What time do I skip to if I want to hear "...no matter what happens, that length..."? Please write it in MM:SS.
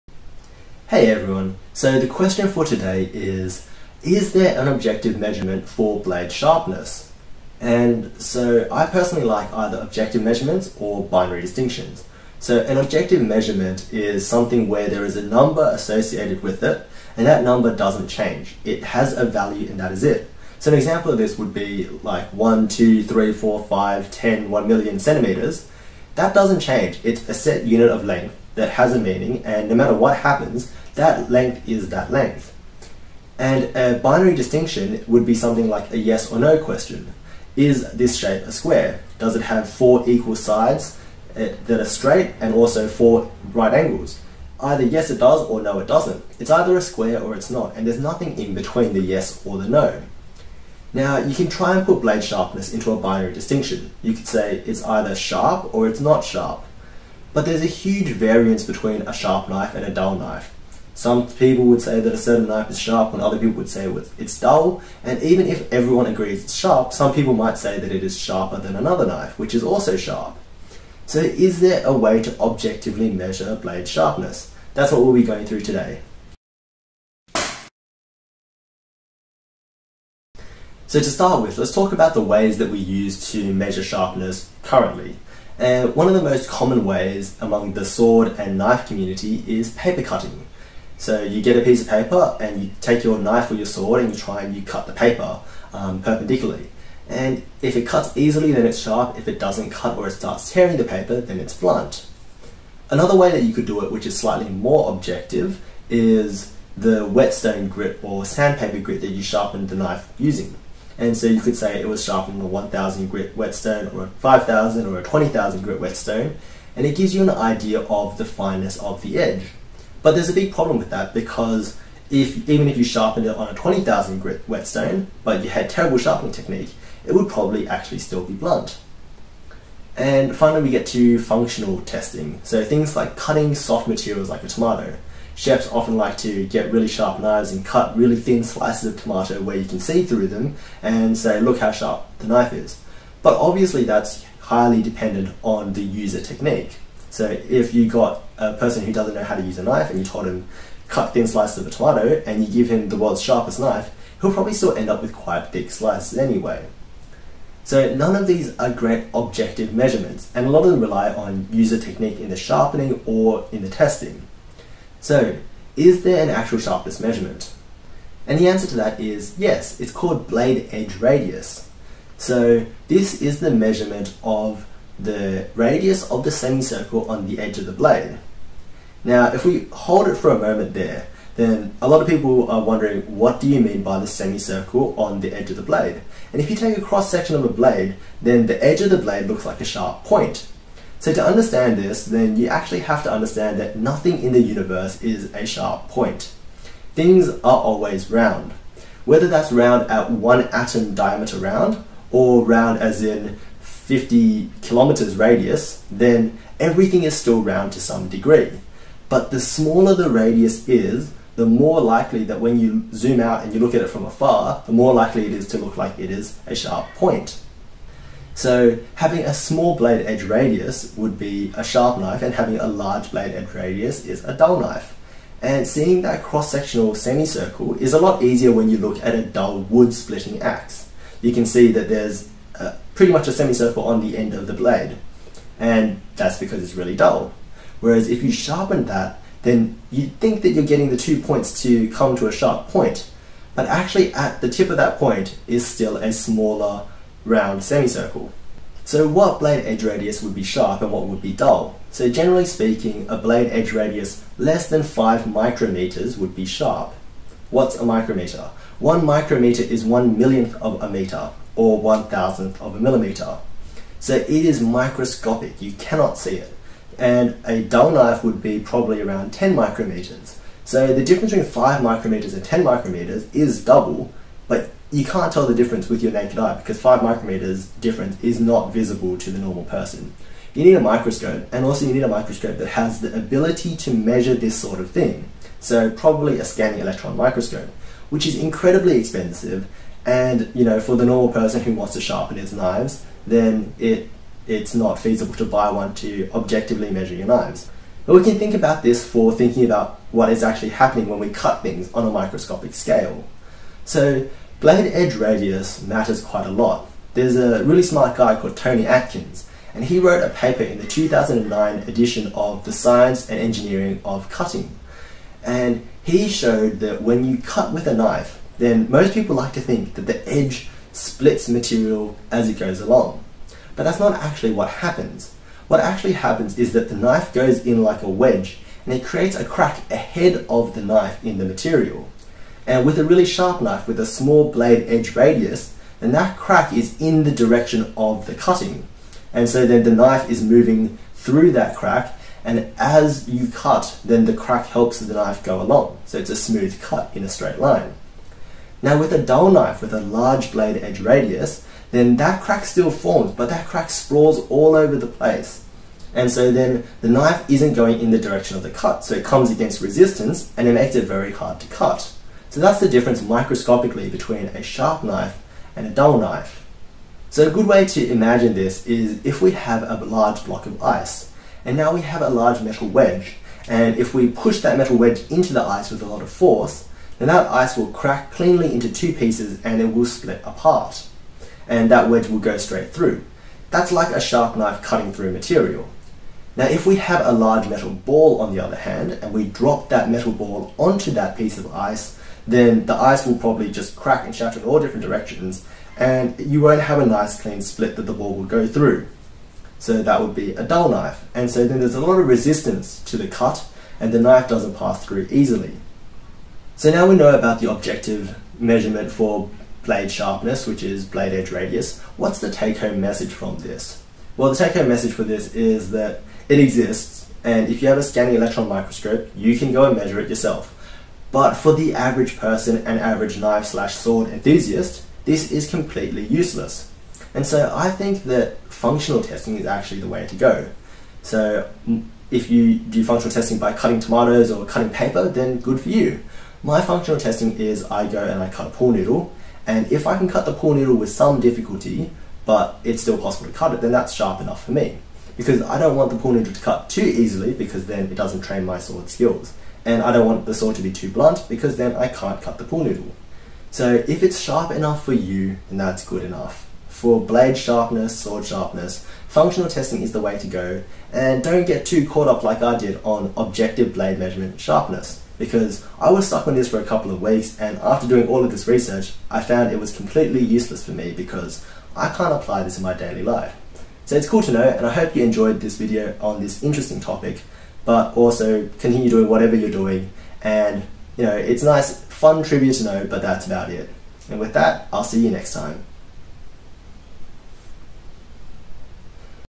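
00:29.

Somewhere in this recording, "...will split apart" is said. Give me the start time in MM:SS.
06:19.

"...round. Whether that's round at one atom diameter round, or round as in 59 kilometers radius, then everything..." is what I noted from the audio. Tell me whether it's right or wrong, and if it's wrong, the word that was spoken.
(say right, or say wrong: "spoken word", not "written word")
wrong: "50", not "59".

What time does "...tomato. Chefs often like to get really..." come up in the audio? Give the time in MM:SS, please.
02:14.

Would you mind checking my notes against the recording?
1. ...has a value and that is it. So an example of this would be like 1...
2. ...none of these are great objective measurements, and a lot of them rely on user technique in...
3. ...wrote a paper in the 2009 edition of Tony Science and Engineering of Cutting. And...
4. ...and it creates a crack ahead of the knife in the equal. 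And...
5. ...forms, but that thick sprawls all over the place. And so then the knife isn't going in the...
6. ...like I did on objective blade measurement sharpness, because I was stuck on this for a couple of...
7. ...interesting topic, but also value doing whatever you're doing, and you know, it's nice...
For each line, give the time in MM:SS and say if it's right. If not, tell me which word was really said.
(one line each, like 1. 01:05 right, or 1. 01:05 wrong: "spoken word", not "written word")
1. 00:18 right
2. 02:37 right
3. 05:09 wrong: "The", not "Tony"
4. 05:28 wrong: "material", not "equal"
5. 05:52 wrong: "crack", not "thick"
6. 07:42 right
7. 07:56 wrong: "continue", not "value".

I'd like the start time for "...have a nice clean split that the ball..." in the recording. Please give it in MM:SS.
06:36.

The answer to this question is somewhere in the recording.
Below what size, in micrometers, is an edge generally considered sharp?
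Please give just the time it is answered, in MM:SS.
04:14.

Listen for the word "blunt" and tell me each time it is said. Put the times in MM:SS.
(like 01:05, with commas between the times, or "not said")
01:41, 02:08, 07:31.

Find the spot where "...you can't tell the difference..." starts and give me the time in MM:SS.
04:34.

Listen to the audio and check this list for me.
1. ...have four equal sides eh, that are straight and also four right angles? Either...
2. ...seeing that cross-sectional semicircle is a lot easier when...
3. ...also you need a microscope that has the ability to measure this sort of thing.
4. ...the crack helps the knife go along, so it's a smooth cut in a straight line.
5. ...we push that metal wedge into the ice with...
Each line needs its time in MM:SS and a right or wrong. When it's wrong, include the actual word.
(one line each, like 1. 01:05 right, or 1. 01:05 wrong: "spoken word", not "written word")
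1. 00:39 right
2. 03:45 right
3. 04:41 right
4. 05:44 right
5. 06:14 right.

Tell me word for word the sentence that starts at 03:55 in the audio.
And that's because it's really dull.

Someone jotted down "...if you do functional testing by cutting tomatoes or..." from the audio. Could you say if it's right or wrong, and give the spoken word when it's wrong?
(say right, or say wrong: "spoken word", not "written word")
right.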